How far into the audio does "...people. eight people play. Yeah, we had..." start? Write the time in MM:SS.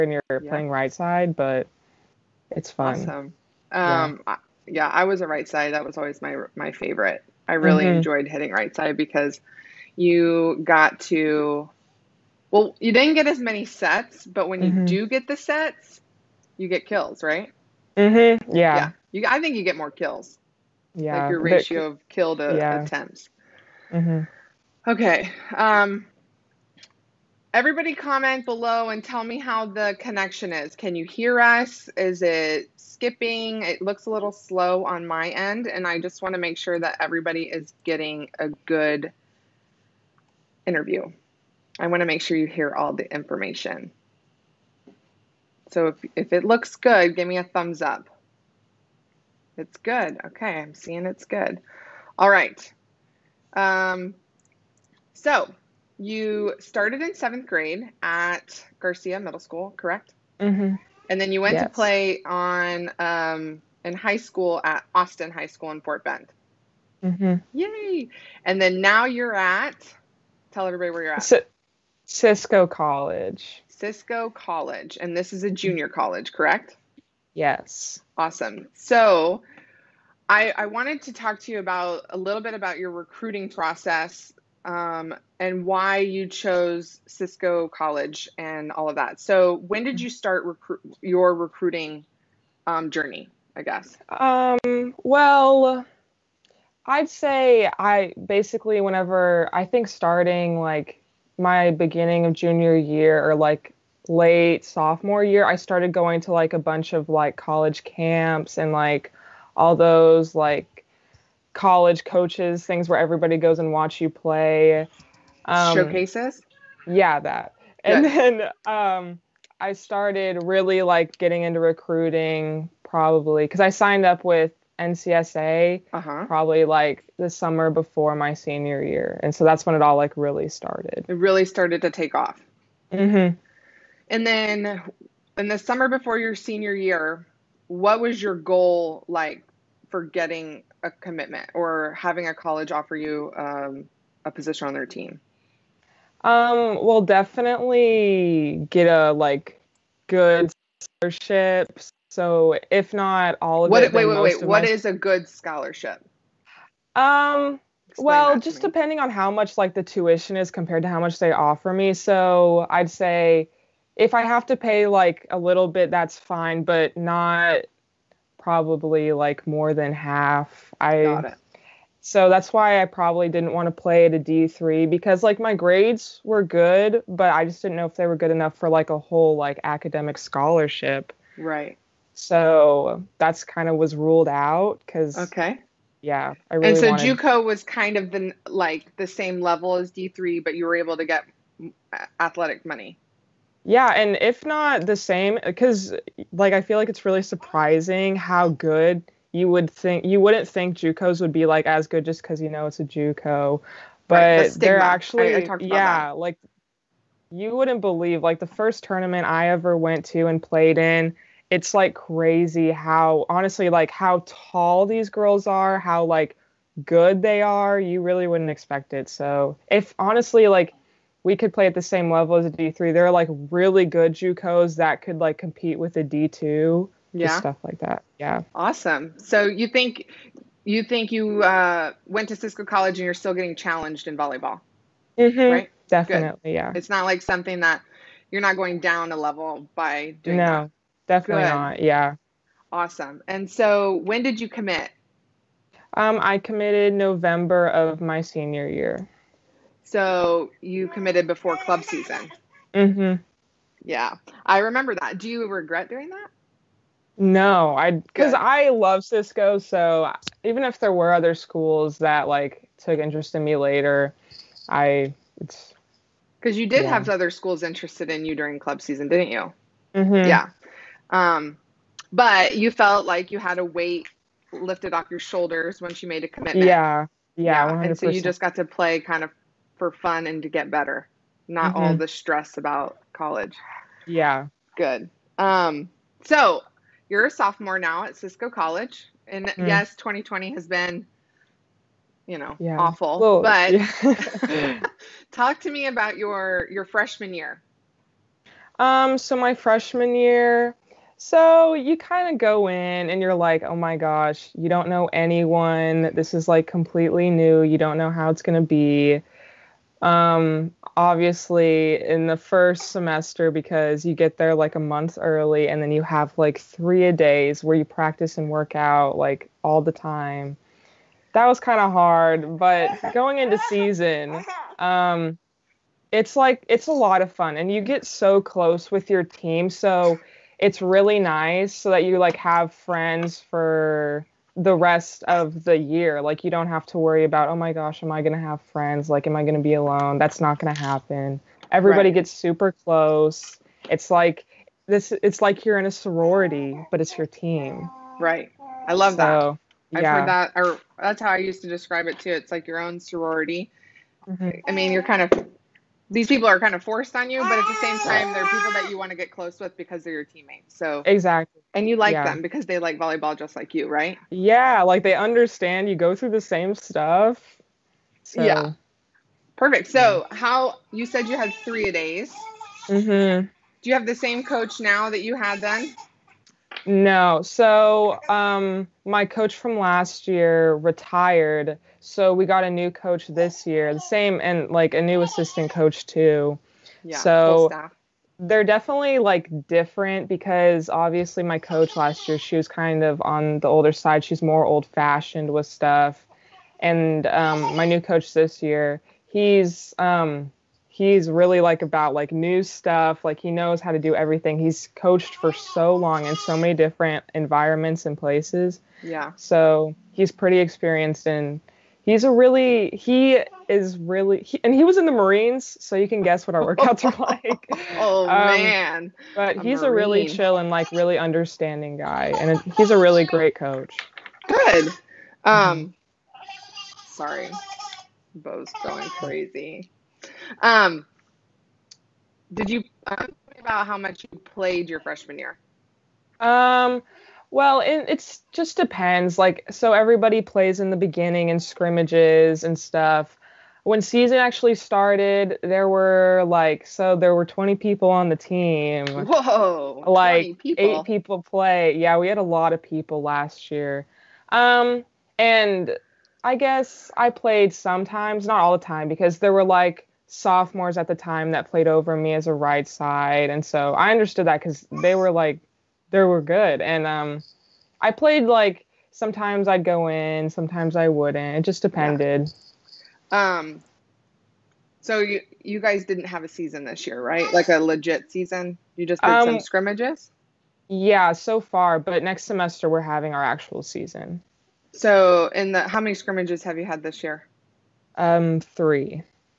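07:30.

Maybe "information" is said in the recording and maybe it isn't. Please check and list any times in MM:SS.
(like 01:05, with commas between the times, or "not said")
00:43.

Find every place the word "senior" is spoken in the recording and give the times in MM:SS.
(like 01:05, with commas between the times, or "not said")
02:08, 02:16, 04:08.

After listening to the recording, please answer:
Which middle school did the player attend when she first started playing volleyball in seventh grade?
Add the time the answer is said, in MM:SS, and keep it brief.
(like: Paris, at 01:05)
Garcia Middle School, at 00:58.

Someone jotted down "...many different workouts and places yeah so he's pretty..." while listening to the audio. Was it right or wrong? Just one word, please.
wrong.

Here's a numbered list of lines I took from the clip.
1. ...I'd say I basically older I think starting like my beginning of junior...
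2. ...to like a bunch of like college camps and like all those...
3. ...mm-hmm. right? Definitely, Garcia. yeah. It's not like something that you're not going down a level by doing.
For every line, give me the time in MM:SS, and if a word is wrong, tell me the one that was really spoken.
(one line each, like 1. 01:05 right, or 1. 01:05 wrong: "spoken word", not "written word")
1. 01:36 wrong: "whenever", not "older"
2. 01:46 right
3. 03:55 wrong: "Good", not "Garcia".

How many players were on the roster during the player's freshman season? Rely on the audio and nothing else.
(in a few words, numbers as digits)
20.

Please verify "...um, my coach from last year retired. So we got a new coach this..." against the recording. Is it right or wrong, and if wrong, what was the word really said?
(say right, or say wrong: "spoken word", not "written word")
right.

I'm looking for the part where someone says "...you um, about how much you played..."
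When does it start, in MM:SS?
07:12.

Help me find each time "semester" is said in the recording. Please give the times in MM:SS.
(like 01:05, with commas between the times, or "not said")
05:12, 08:02.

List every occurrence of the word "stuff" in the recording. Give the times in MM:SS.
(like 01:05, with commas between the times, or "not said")
03:47, 06:06, 06:35, 06:42, 07:22.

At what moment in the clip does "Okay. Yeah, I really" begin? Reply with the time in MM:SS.
03:05.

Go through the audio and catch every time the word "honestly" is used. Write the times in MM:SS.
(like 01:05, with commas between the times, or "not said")
03:33, 03:39.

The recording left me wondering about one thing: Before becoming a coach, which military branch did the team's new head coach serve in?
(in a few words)
Marines.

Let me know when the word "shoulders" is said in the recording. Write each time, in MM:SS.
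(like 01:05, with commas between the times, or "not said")
04:35.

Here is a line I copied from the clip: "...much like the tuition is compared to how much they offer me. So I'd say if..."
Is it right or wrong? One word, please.
right.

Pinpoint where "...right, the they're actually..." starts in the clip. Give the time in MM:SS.
03:24.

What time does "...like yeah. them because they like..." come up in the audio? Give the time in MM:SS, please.
06:01.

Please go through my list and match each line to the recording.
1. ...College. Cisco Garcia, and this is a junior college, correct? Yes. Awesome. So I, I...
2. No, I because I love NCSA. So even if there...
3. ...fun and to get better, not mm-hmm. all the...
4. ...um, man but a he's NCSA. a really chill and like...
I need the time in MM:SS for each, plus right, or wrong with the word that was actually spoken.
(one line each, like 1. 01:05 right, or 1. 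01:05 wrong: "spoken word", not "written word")
1. 01:12 wrong: "College", not "Garcia"
2. 04:17 wrong: "Cisco", not "NCSA"
3. 04:39 right
4. 06:58 wrong: "Marine", not "NCSA".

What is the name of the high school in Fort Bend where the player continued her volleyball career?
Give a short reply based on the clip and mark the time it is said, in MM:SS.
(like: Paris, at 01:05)
Austin High School, at 01:04.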